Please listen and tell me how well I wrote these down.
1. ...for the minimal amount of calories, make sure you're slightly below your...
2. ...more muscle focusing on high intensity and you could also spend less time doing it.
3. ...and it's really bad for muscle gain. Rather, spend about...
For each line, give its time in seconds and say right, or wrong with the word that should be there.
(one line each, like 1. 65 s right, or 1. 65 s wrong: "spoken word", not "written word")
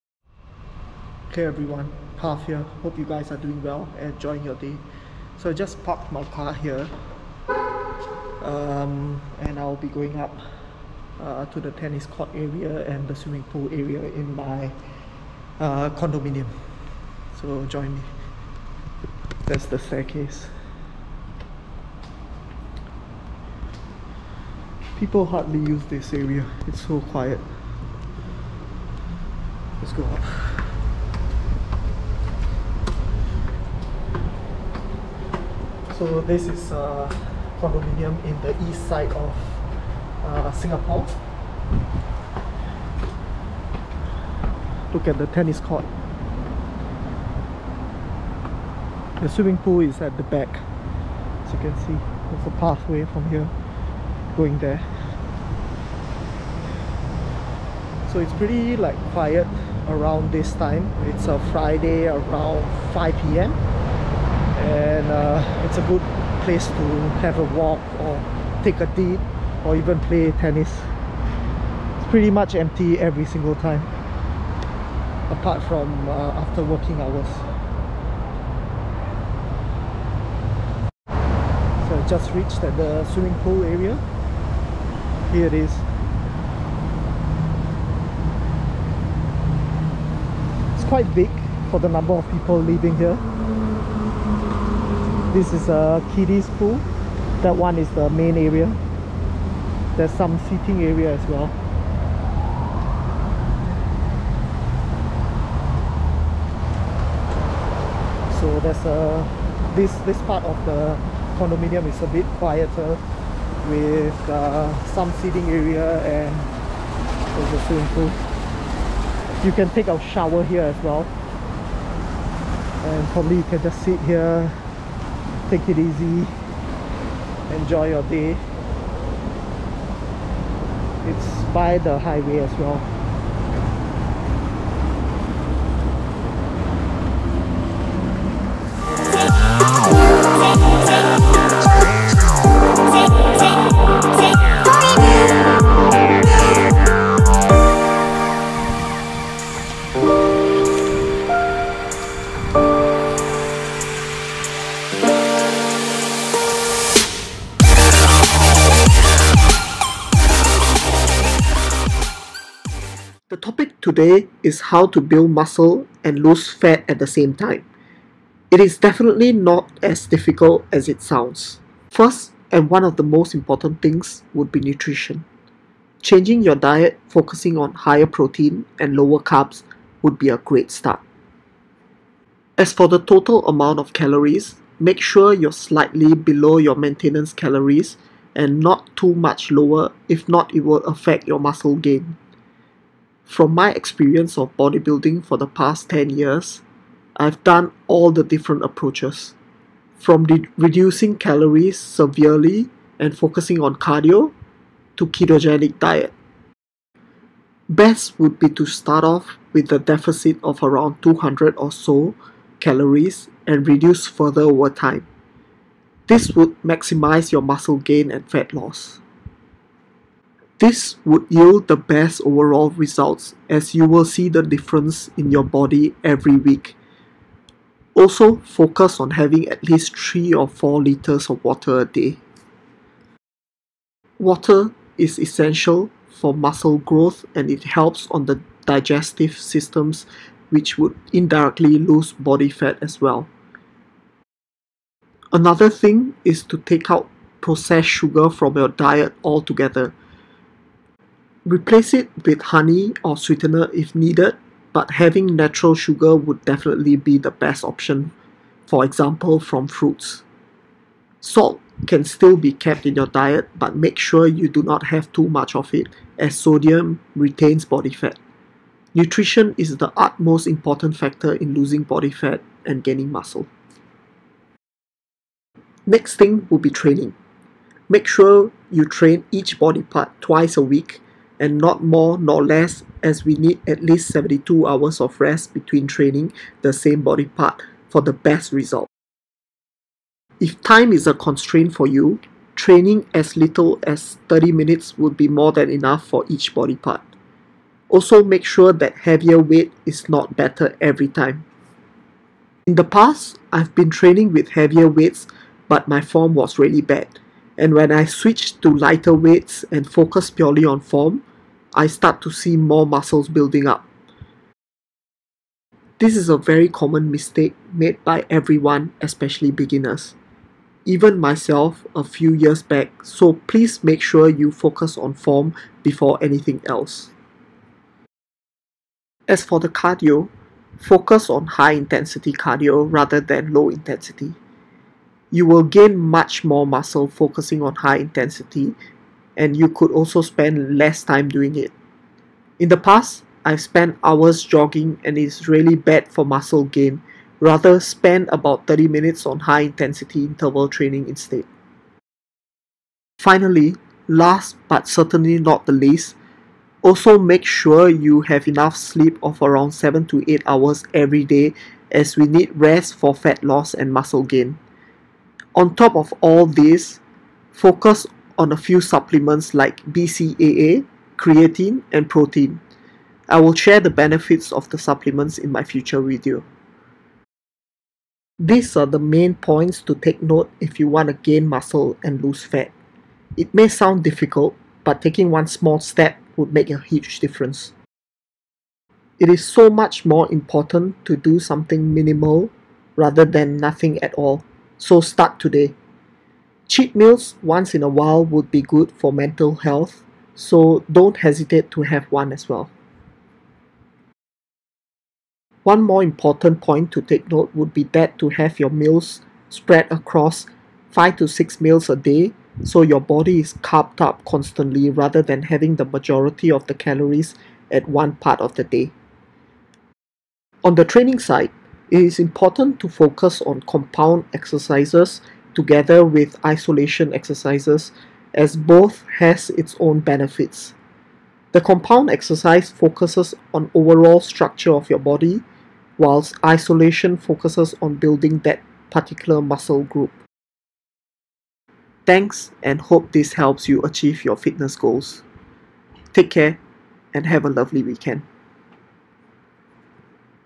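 1. 182 s wrong: "total", not "minimal"
2. 336 s right
3. 345 s right.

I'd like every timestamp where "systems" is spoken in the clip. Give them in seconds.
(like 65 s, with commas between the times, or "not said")
239 s.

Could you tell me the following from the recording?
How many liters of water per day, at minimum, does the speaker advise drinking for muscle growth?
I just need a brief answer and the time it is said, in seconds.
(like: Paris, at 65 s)
3 or 4 liters, at 229 s.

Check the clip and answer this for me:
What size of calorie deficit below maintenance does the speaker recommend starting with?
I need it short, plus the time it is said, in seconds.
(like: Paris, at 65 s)
200, at 211 s.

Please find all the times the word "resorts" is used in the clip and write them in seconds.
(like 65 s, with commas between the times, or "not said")
not said.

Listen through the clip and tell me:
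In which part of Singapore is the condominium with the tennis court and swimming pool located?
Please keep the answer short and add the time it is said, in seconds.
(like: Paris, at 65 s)
east side, at 38 s.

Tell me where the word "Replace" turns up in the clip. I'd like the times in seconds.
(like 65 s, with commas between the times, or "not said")
251 s.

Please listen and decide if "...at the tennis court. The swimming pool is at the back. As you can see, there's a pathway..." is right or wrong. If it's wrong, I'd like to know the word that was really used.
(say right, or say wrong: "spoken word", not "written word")
right.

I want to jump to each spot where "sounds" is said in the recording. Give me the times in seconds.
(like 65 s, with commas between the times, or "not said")
171 s, 383 s.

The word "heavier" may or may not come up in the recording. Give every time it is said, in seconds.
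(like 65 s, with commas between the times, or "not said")
299 s, 304 s.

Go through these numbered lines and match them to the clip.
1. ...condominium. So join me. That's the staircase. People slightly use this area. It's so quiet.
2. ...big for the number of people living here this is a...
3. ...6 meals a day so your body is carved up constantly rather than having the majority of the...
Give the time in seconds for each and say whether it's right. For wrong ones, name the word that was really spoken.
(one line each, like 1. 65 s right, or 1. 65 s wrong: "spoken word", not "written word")
1. 15 s wrong: "hardly", not "slightly"
2. 91 s right
3. 411 s right.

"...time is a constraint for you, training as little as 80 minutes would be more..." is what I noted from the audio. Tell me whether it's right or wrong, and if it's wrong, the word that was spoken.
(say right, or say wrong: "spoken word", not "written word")
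wrong: "30", not "80".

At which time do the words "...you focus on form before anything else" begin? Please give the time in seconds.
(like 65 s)
324 s.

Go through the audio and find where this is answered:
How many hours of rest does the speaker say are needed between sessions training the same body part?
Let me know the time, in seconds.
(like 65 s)
284 s.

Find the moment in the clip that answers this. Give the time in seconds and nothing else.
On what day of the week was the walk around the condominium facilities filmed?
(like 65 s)
61 s.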